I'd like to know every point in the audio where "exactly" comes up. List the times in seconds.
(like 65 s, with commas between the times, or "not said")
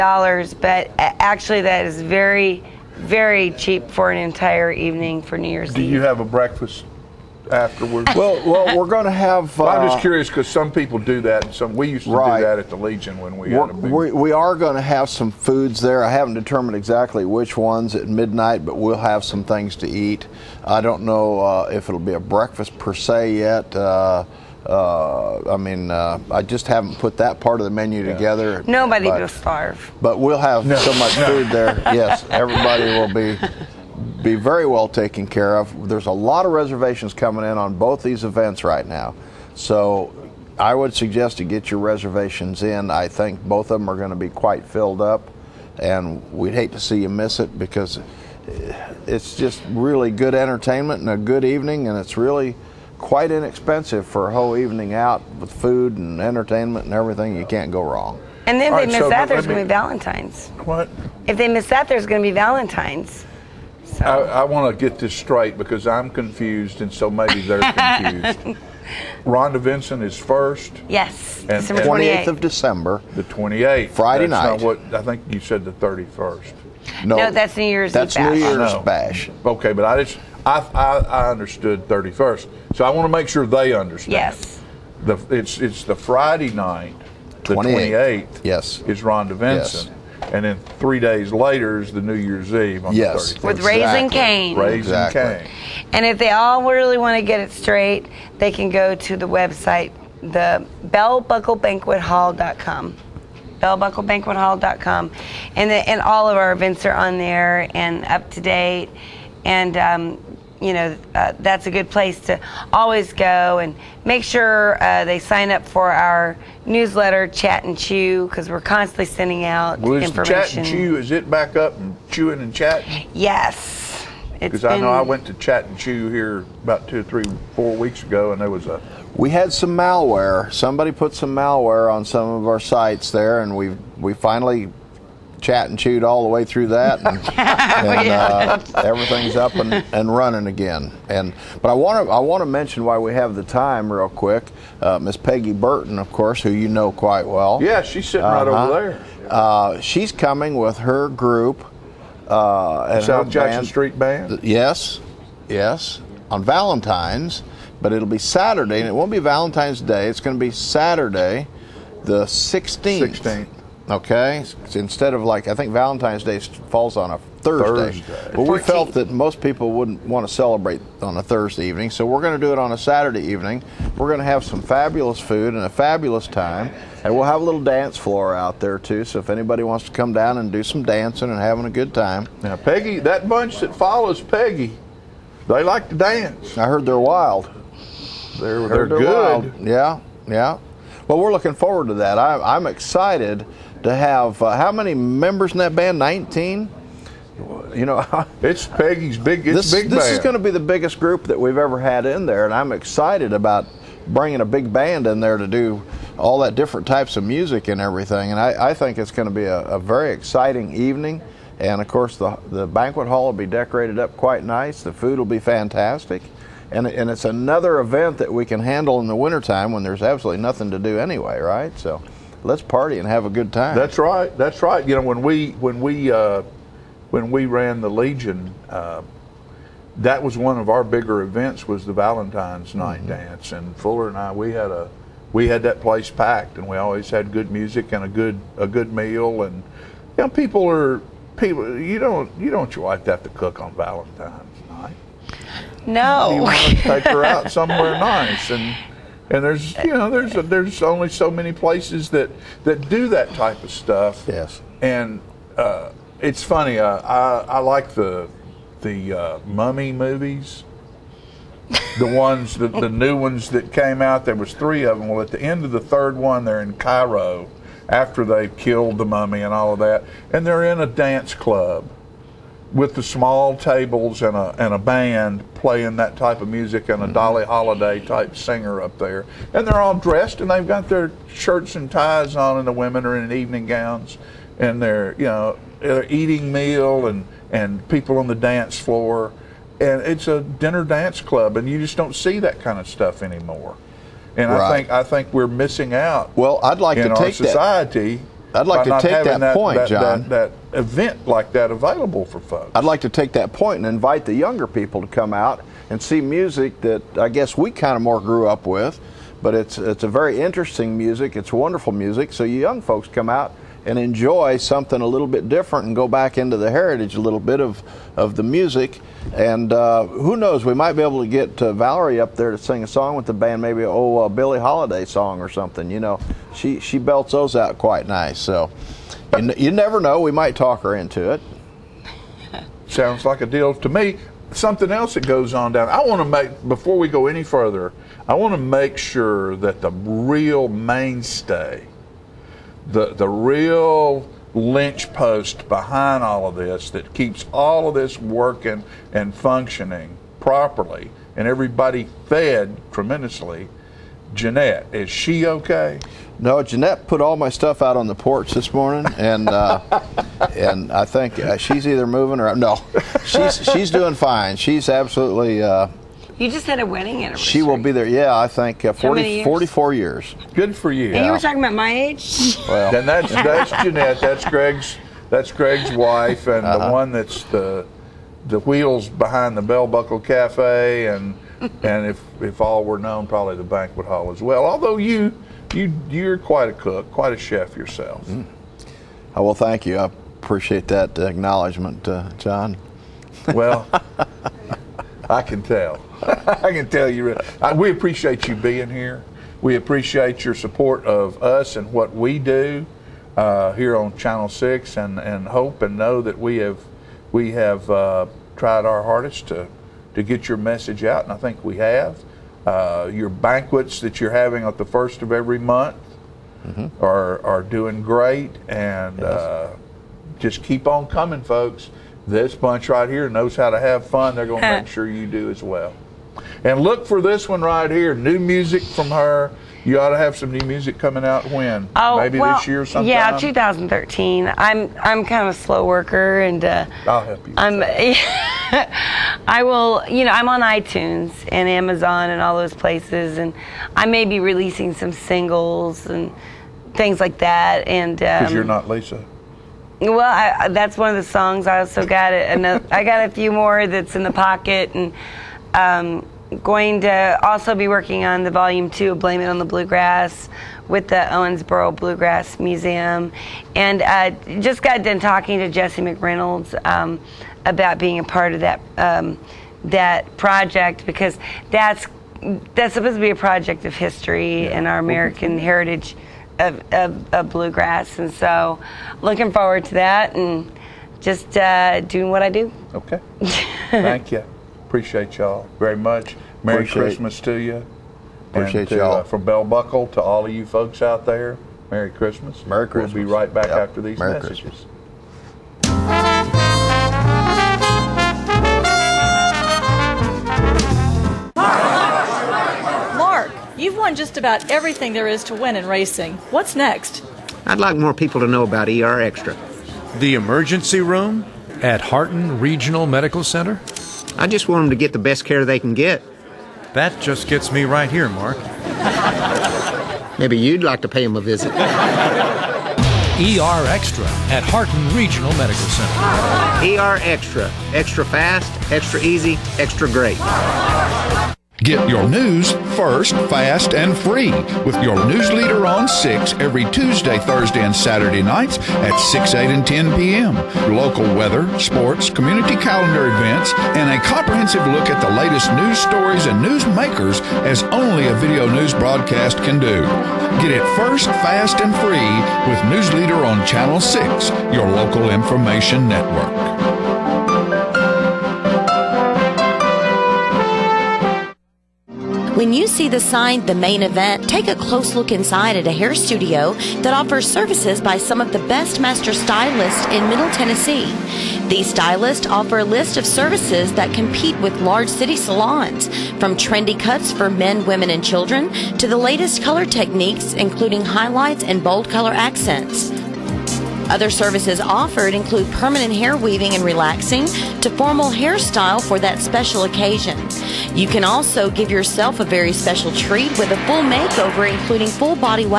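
16 s, 94 s.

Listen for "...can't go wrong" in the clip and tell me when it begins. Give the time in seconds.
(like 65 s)
57 s.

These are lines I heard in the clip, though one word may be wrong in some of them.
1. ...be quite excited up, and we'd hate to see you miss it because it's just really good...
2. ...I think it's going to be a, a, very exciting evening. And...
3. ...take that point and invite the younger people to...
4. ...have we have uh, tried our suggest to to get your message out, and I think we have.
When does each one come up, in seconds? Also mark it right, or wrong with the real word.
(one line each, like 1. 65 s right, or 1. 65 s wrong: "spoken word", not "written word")
1. 44 s wrong: "filled", not "excited"
2. 208 s right
3. 303 s right
4. 406 s wrong: "hardest", not "suggest".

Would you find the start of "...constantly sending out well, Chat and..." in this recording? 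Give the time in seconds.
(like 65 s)
118 s.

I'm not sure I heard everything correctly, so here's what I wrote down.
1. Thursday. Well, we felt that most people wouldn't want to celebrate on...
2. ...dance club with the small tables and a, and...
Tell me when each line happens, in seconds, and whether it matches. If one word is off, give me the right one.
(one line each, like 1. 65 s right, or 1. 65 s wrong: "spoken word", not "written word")
1. 168 s right
2. 270 s right.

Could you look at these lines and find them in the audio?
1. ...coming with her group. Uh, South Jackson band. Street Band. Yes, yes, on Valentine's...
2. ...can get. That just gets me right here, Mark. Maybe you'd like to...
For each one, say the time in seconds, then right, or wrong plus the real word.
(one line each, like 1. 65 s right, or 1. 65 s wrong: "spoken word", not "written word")
1. 150 s right
2. 515 s right.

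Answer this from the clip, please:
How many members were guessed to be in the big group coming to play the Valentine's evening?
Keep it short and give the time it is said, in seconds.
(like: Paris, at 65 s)
19, at 195 s.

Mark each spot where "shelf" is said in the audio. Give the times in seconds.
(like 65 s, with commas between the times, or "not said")
not said.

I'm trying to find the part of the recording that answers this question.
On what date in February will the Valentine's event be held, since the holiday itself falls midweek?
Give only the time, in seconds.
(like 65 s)
162 s.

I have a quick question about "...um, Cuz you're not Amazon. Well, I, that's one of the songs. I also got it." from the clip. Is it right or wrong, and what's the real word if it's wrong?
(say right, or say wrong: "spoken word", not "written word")
wrong: "Lisa", not "Amazon".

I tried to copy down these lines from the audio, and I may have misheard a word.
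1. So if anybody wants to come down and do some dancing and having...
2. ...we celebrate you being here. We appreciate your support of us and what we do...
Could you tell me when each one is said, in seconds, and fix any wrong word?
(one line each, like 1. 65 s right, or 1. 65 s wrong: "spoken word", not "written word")
1. 179 s right
2. 397 s wrong: "appreciate", not "celebrate".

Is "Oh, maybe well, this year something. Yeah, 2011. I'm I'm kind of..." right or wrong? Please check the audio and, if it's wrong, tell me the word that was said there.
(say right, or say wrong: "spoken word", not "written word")
wrong: "2013", not "2011".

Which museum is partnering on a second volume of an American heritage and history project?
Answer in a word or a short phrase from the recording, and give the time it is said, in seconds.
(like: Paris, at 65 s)
Owensboro Bluegrass Museum, at 461 s.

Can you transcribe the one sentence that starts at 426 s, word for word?
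And look for this one right here.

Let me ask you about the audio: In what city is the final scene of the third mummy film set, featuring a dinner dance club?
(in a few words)
Cairo.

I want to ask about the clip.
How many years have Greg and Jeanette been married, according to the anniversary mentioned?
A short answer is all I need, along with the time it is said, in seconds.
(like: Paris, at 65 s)
44, at 369 s.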